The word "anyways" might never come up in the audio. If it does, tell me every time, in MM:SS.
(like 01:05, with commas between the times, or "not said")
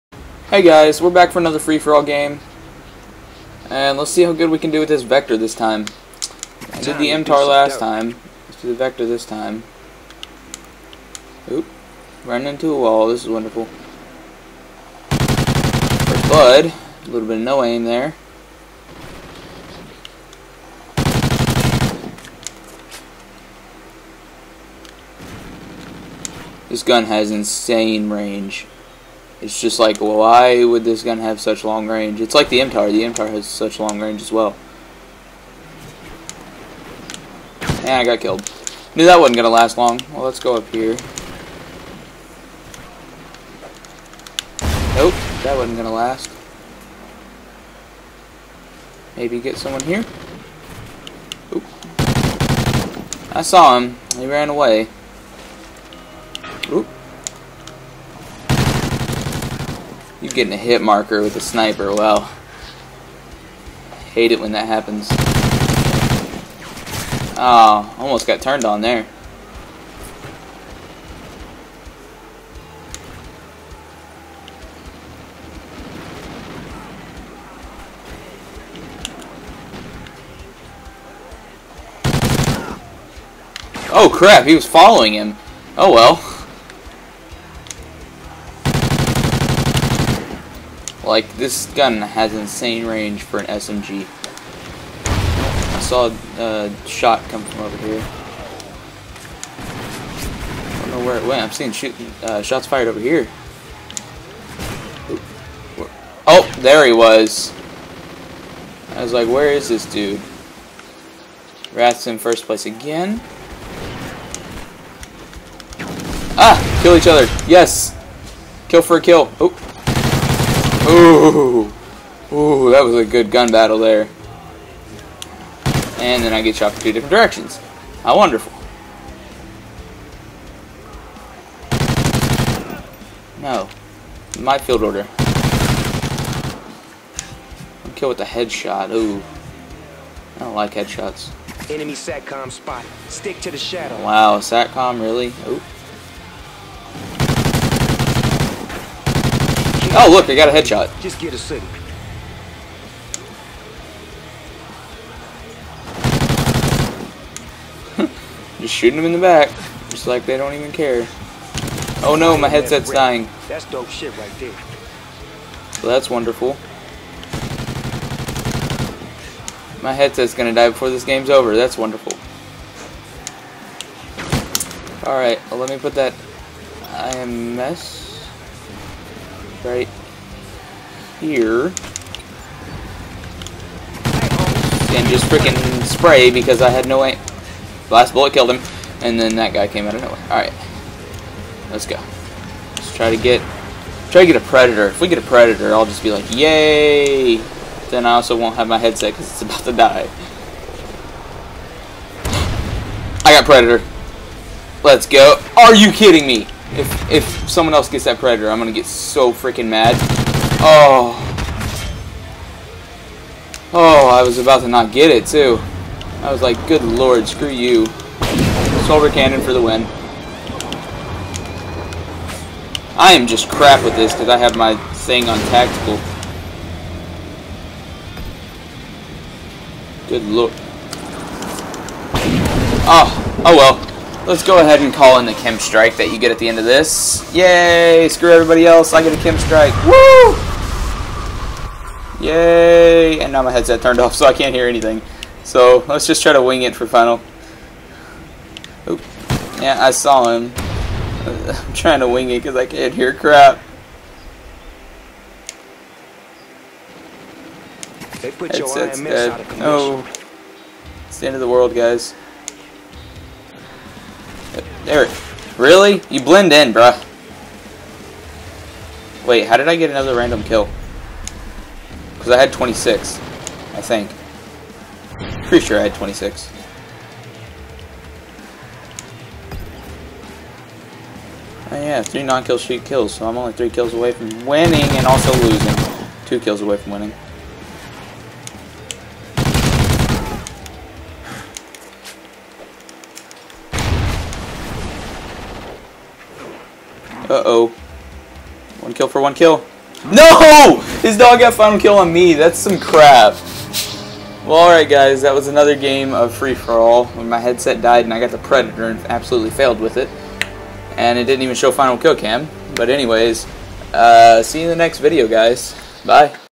05:12.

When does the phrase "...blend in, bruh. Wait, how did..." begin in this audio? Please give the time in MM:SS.
04:26.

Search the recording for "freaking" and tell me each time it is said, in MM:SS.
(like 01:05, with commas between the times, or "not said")
03:05, 03:29.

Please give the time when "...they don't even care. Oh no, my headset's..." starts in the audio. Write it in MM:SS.
02:40.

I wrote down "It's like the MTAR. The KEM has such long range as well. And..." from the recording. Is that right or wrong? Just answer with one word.
wrong.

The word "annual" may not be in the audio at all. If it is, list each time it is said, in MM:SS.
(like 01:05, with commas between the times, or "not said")
not said.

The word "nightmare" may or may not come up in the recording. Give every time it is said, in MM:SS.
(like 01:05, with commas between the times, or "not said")
not said.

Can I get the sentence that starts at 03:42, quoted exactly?
I am just crap with this because I have my thing on tactical.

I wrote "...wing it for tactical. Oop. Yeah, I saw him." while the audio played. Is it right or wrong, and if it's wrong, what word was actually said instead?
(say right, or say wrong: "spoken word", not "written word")
wrong: "final", not "tactical".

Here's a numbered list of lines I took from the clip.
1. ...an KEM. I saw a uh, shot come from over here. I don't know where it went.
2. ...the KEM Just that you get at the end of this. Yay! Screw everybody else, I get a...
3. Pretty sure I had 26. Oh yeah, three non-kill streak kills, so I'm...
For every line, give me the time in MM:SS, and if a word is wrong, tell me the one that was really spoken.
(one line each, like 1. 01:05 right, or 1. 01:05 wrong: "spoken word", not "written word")
1. 01:33 wrong: "SMG", not "KEM"
2. 03:55 wrong: "Strike", not "Just"
3. 04:35 right.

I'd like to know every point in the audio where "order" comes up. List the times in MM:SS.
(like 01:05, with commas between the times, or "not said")
02:14.